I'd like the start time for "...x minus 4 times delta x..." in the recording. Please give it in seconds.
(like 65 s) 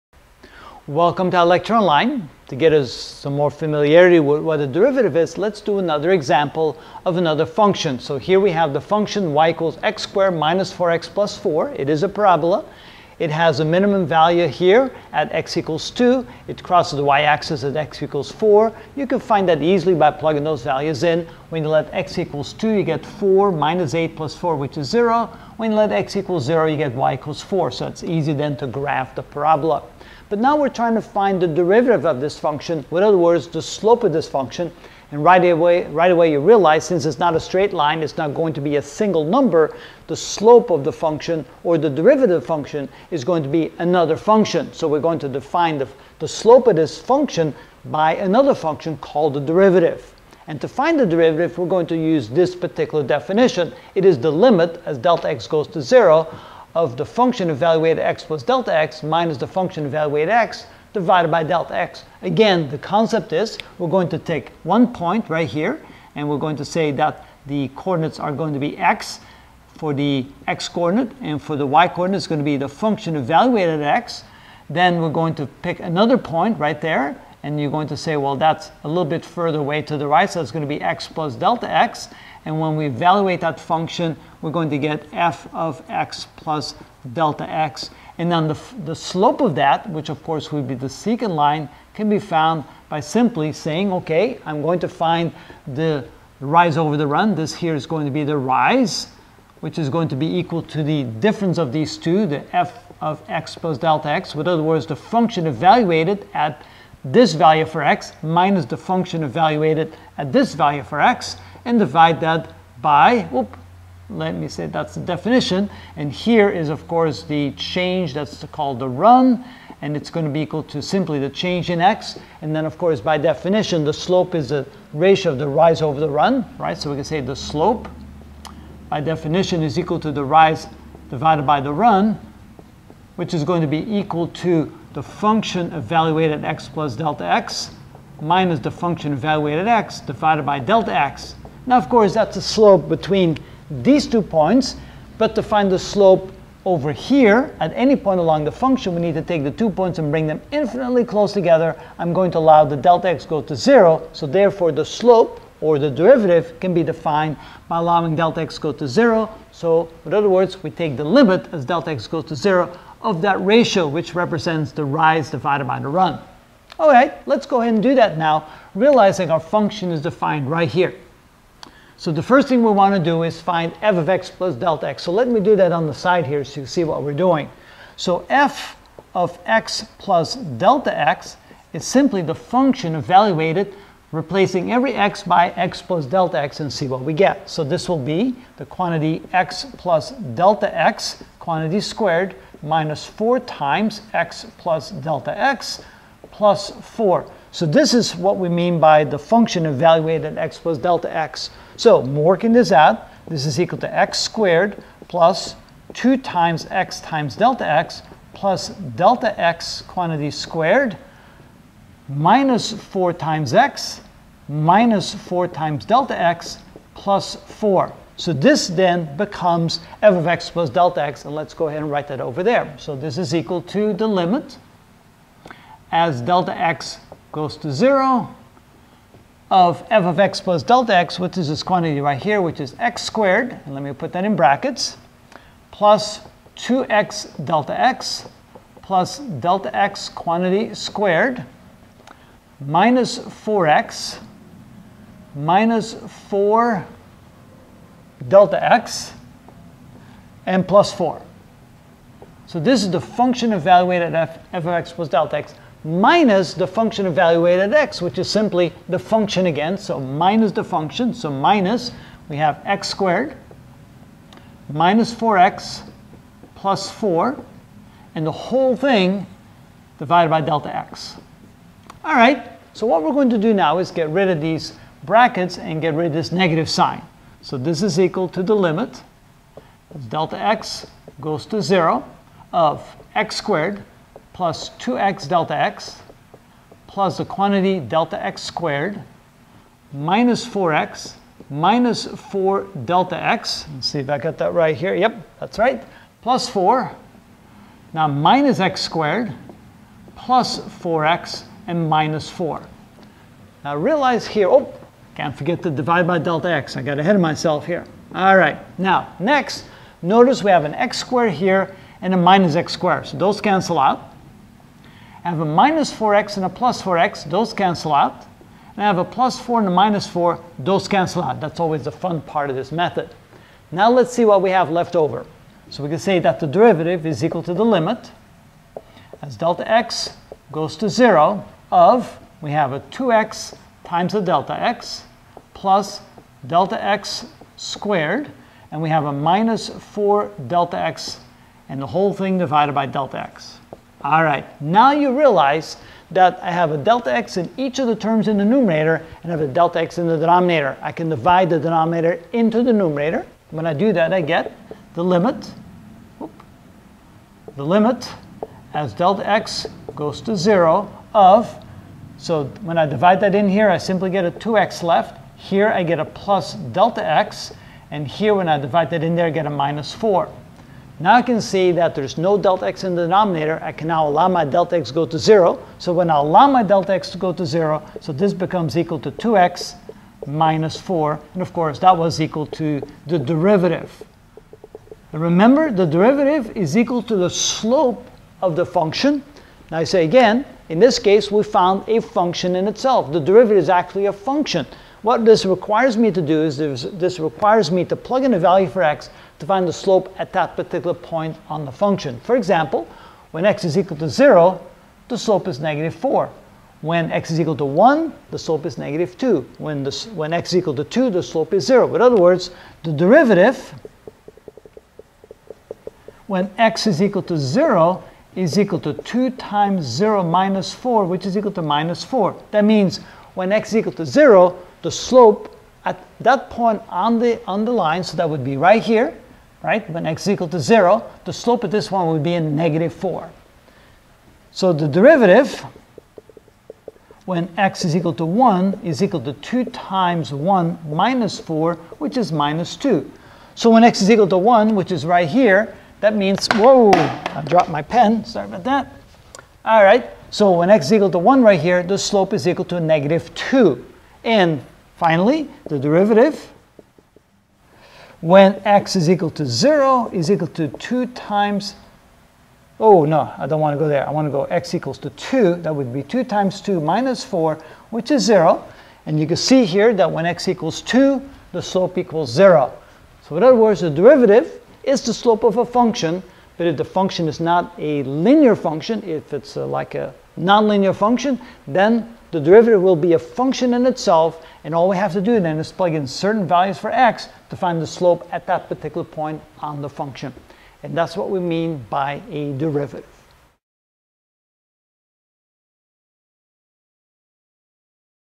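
213 s.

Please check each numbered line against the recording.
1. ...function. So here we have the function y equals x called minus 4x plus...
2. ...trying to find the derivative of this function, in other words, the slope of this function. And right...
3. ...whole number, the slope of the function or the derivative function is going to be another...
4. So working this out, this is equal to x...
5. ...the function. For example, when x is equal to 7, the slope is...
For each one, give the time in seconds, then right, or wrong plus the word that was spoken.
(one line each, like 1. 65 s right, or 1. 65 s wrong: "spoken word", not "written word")
1. 7 s wrong: "squared", not "called"
2. 30 s right
3. 38 s wrong: "single", not "whole"
4. 201 s right
5. 401 s wrong: "0", not "7".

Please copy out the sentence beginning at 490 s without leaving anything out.
And that's what we mean by a derivative.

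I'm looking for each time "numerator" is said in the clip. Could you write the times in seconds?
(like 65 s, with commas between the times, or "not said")
348 s, 352 s.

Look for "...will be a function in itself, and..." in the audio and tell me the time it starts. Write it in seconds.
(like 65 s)
482 s.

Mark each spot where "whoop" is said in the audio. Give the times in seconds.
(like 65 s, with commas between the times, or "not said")
113 s, 356 s.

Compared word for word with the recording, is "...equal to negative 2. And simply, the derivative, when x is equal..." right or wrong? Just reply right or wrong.
wrong.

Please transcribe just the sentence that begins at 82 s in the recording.
And when we evaluate that function, we're going to get f of x plus delta x.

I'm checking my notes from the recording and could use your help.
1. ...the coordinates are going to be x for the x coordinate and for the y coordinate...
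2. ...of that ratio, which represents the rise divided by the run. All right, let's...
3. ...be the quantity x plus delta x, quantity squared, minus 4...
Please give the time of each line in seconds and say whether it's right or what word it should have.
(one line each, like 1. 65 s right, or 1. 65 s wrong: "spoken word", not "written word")
1. 67 s right
2. 163 s right
3. 187 s right.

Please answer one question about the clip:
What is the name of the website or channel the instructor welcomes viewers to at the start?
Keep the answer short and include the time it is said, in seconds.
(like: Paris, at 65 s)
ilectureonline, at 1 s.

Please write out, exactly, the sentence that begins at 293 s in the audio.
Let's see if I got that right here.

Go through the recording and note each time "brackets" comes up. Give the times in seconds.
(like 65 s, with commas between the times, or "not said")
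234 s, 275 s.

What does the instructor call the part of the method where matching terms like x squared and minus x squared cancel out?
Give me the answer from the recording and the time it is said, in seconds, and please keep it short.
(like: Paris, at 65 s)
the fun part, at 321 s.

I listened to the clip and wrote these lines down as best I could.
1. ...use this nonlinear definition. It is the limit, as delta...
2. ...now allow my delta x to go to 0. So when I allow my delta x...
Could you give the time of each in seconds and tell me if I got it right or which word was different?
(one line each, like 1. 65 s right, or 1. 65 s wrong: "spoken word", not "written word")
1. 51 s wrong: "particular", not "nonlinear"
2. 373 s right.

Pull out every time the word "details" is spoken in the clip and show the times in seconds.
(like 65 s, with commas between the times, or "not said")
not said.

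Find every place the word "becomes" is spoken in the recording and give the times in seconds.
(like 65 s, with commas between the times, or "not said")
219 s, 378 s.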